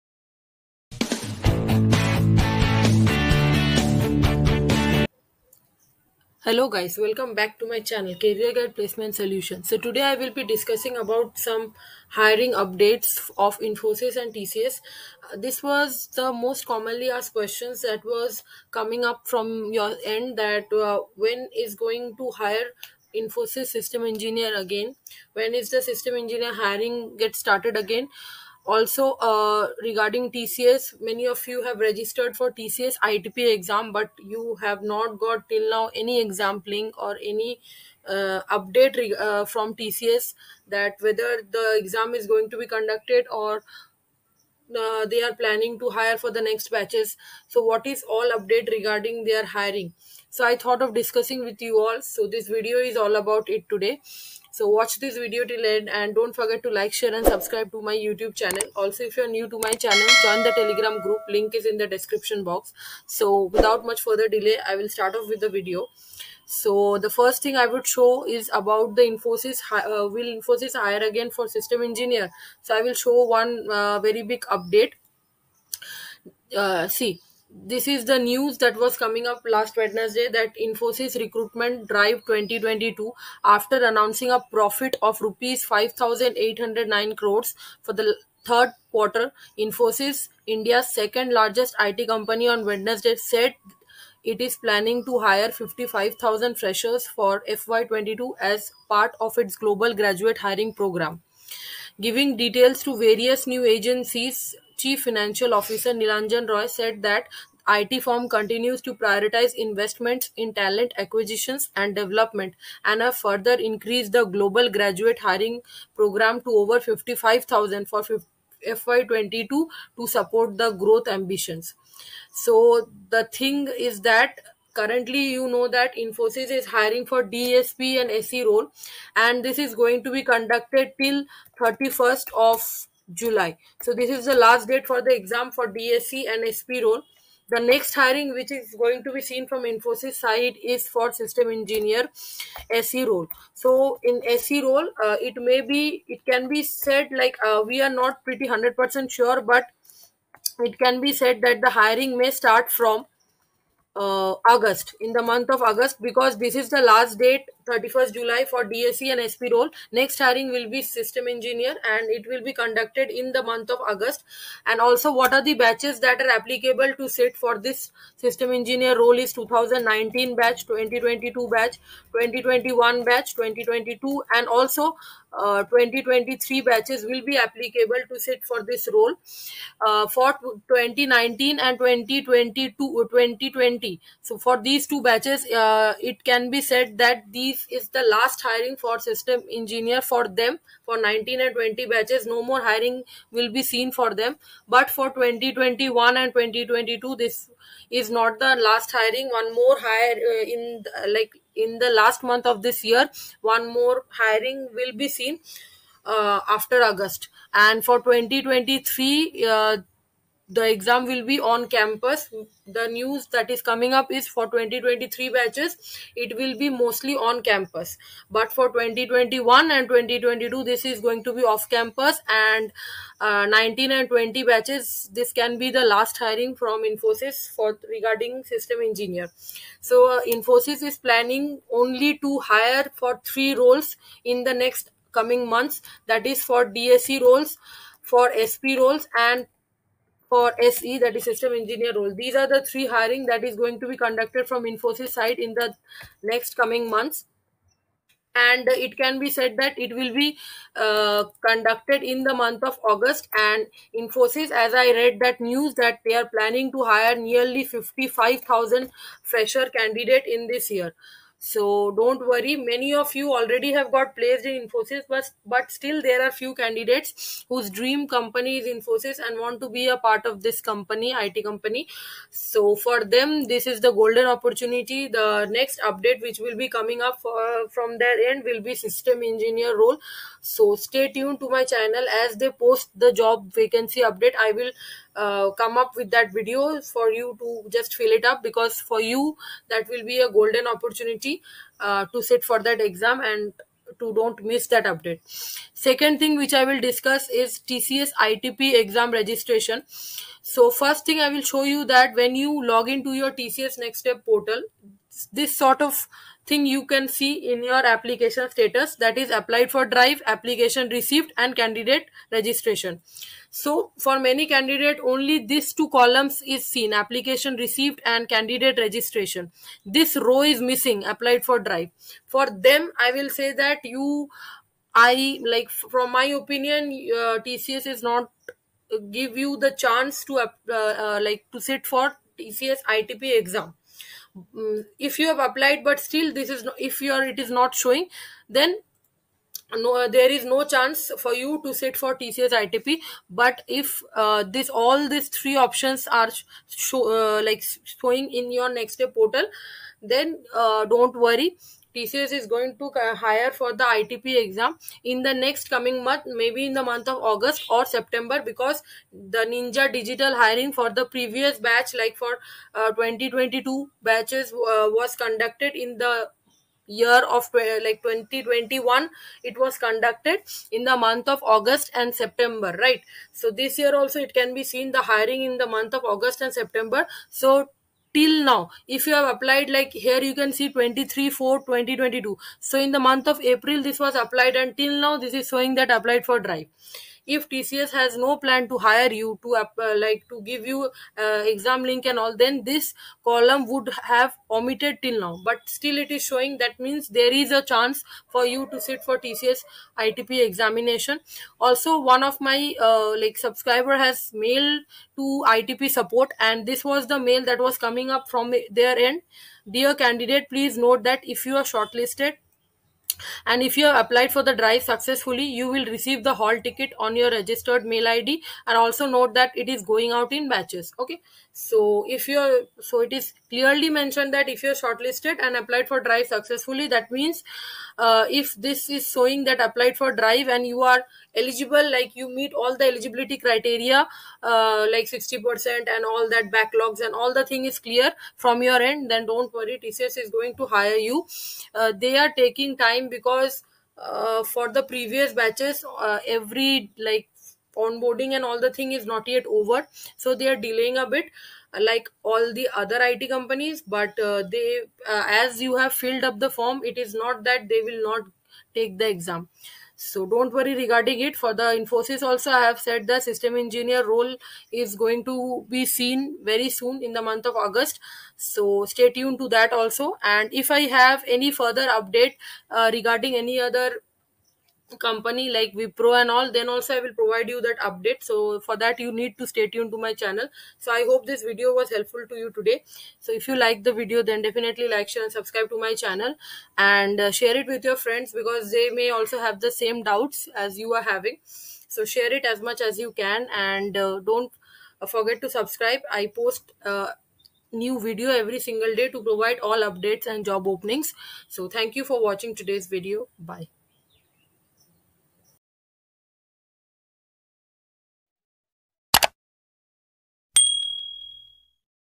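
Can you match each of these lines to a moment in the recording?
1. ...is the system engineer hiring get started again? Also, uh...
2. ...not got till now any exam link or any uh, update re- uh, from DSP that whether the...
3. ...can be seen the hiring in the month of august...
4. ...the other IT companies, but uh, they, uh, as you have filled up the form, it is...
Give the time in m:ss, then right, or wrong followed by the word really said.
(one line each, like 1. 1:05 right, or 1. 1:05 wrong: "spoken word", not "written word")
1. 0:25 right
2. 0:34 wrong: "TCS", not "DSP"
3. 6:14 right
4. 7:32 right.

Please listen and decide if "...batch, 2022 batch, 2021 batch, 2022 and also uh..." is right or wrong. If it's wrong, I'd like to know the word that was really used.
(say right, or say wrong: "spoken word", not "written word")
right.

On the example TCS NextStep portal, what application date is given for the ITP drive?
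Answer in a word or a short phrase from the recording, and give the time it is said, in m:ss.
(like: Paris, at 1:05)
23/4/2022, at 6:20.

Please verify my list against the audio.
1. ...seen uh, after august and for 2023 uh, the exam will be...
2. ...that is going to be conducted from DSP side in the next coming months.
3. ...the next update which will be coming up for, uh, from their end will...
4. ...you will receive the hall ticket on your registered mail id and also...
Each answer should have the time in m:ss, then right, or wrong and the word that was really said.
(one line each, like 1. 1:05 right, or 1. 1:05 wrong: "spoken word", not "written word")
1. 3:25 right
2. 4:03 wrong: "Infosys", not "DSP"
3. 4:35 right
4. 6:55 right.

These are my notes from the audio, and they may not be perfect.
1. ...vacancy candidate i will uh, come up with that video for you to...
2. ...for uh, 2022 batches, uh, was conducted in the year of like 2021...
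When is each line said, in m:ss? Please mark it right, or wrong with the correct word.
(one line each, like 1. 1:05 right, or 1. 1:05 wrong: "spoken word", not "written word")
1. 4:43 wrong: "update", not "candidate"
2. 6:02 right.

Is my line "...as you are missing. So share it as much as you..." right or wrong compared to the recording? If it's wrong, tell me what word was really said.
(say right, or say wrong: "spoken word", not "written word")
wrong: "having", not "missing".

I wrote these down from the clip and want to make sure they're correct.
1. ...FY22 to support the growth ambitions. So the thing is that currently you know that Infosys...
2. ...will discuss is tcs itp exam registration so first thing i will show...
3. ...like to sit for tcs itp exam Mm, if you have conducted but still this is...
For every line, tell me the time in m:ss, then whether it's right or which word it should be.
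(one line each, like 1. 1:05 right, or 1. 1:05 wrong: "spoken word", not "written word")
1. 1:58 right
2. 4:56 right
3. 5:31 wrong: "applied", not "conducted".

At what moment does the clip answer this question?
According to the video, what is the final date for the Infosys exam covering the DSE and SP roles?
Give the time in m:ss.
2:11.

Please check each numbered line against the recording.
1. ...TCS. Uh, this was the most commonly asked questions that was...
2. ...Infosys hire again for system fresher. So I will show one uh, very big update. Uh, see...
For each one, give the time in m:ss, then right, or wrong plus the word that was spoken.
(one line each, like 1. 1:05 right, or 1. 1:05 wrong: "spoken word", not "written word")
1. 0:14 right
2. 1:10 wrong: "engineer", not "fresher".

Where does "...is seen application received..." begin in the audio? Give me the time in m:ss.
5:16.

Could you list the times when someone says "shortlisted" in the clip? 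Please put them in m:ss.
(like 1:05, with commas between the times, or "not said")
6:51, 7:04.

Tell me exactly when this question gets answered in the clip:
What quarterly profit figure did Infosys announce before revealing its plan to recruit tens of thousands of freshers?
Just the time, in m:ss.
1:25.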